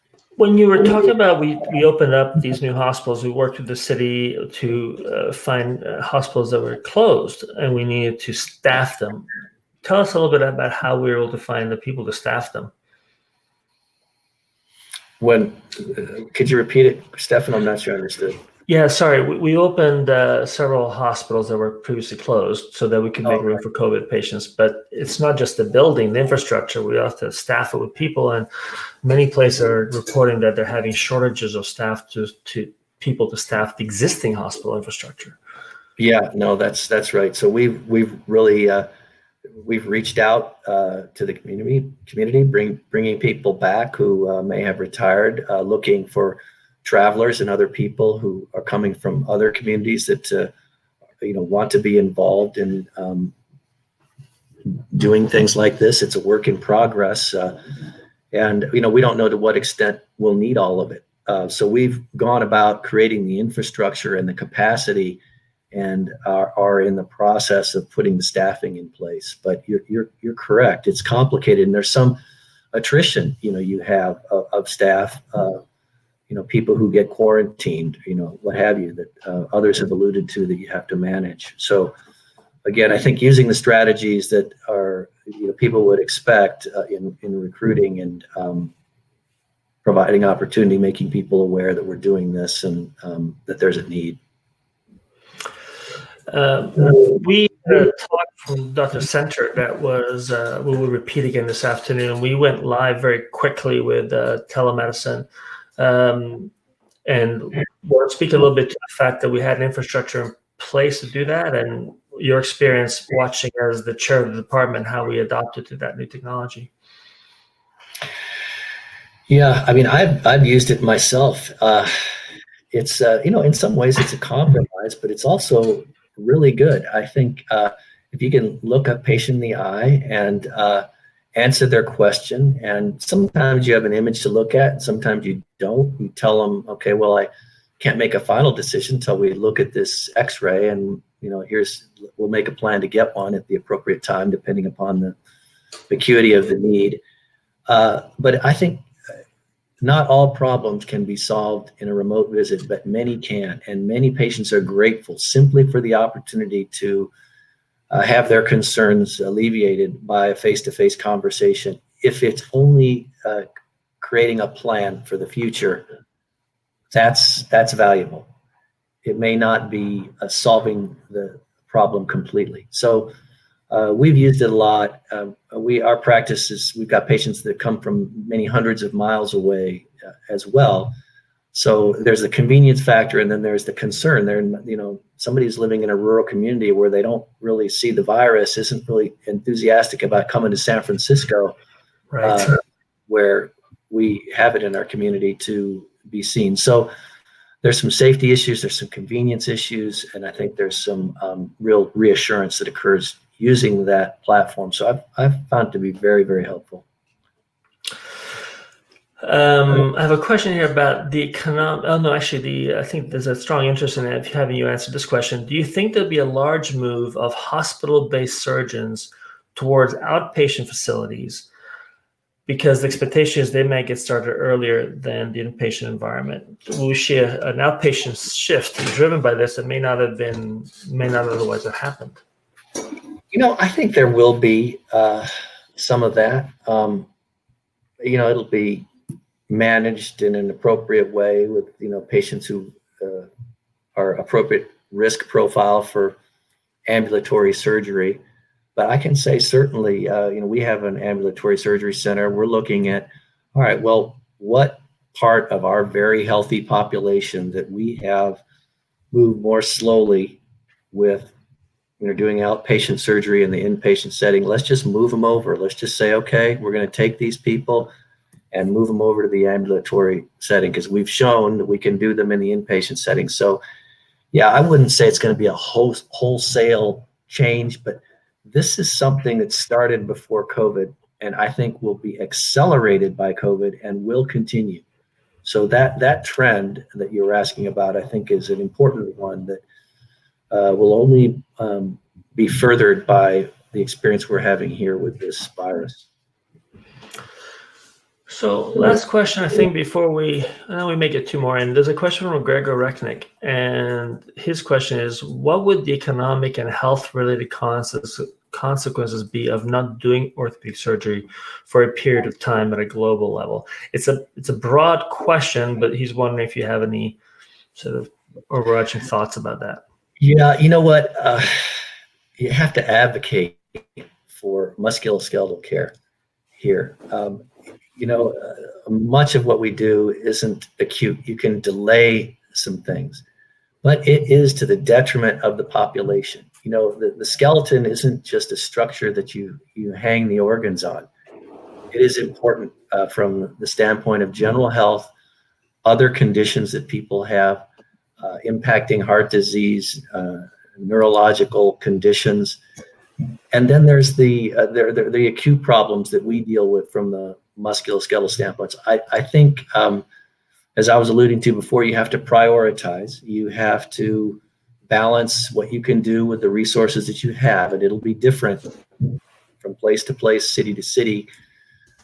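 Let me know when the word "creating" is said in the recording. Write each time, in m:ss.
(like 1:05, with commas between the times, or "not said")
1:02, 2:43.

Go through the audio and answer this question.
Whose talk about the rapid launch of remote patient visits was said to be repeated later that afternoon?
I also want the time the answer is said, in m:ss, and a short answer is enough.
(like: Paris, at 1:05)
Dr. Center, at 1:38.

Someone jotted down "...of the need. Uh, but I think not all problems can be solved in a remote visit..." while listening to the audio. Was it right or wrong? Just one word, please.
right.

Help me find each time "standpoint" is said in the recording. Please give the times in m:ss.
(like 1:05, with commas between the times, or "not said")
5:43, 5:58.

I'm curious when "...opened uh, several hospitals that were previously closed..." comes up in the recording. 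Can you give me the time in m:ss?
0:19.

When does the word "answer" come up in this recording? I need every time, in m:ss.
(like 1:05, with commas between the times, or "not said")
2:11, 3:34.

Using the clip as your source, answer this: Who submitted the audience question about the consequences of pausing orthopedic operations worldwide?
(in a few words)
Gregor Rechnik.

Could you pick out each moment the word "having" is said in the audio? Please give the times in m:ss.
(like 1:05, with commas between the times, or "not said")
0:30, 3:34, 4:54.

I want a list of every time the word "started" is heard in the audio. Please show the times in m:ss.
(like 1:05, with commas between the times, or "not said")
3:43, 4:39.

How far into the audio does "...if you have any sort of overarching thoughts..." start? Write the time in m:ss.
5:16.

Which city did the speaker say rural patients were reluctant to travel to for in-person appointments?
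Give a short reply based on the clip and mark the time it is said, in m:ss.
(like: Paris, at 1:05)
San Francisco, at 3:10.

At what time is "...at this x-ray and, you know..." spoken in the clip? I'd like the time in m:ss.
2:19.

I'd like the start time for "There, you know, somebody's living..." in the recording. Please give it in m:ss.
3:04.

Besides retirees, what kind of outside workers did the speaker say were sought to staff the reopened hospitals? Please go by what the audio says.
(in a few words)
Travelers.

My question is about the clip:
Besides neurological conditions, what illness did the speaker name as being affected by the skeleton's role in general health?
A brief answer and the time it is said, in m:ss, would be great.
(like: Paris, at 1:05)
Heart disease, at 5:49.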